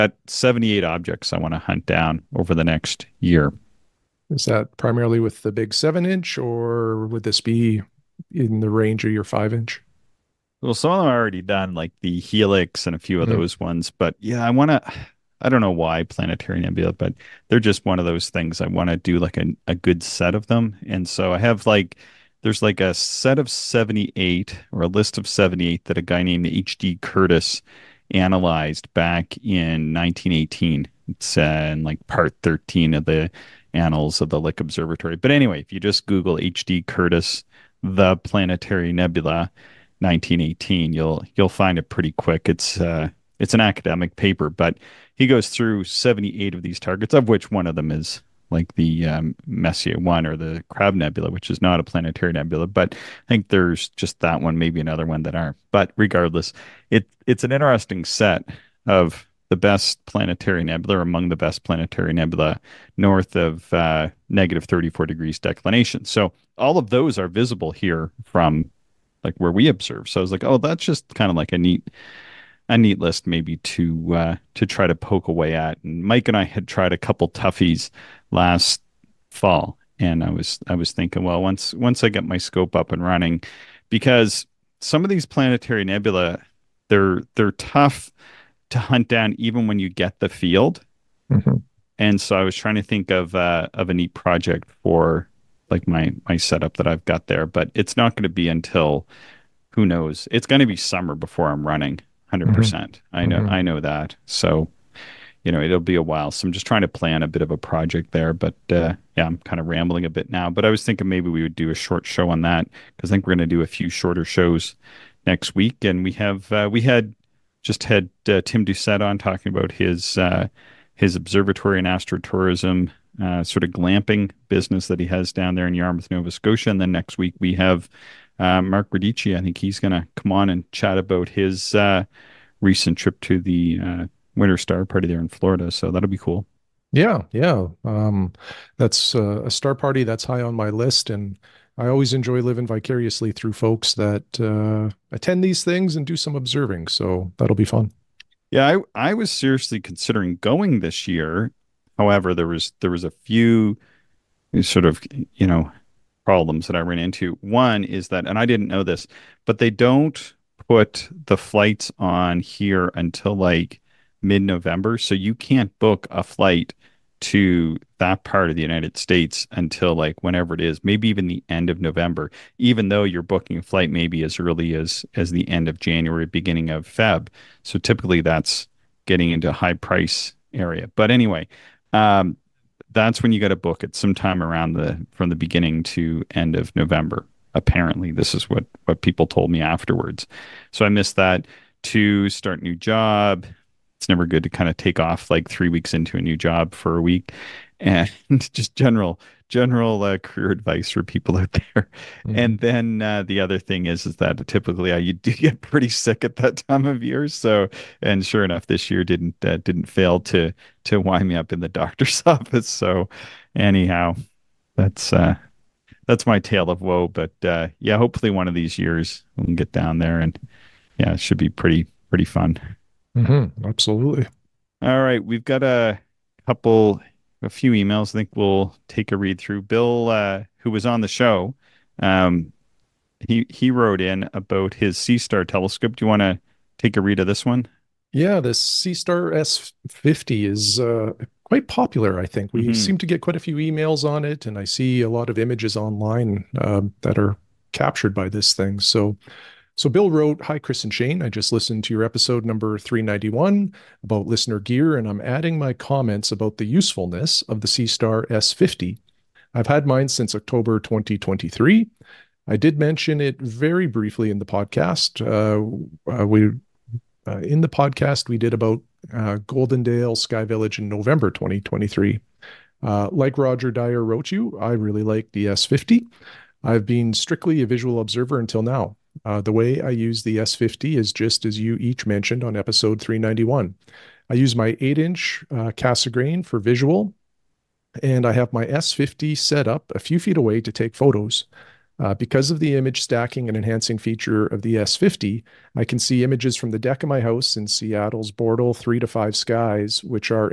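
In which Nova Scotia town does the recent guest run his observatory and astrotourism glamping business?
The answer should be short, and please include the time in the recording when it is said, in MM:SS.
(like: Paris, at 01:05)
Yarmouth, at 02:05.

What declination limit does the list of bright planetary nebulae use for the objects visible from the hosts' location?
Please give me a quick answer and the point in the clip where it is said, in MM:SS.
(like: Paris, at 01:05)
-34 degrees, at 01:04.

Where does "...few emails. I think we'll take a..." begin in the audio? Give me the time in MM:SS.
03:47.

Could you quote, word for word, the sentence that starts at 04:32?
Uh, like Roger Dyer wrote you, I really like the S50.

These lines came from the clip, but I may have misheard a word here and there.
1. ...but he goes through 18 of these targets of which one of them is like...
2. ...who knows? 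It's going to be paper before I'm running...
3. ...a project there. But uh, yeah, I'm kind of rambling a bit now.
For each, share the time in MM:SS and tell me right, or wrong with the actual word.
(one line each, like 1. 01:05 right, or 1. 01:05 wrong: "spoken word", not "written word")
1. 00:44 wrong: "78", not "18"
2. 01:39 wrong: "summer", not "paper"
3. 01:47 right.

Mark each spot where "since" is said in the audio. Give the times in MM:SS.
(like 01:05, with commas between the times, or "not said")
04:20.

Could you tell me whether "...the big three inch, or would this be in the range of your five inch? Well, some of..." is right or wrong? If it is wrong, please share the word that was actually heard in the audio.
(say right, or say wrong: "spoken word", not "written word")
wrong: "seven", not "three".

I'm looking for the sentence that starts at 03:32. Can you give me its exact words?
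So, anyhow, that's uh, that's my tale of woe.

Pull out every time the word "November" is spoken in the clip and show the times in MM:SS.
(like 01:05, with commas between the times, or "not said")
02:44, 02:51, 03:06, 04:30.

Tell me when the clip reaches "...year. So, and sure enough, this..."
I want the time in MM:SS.
03:27.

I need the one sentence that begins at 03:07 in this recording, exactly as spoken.
Apparently, this is what what people told me afterwards.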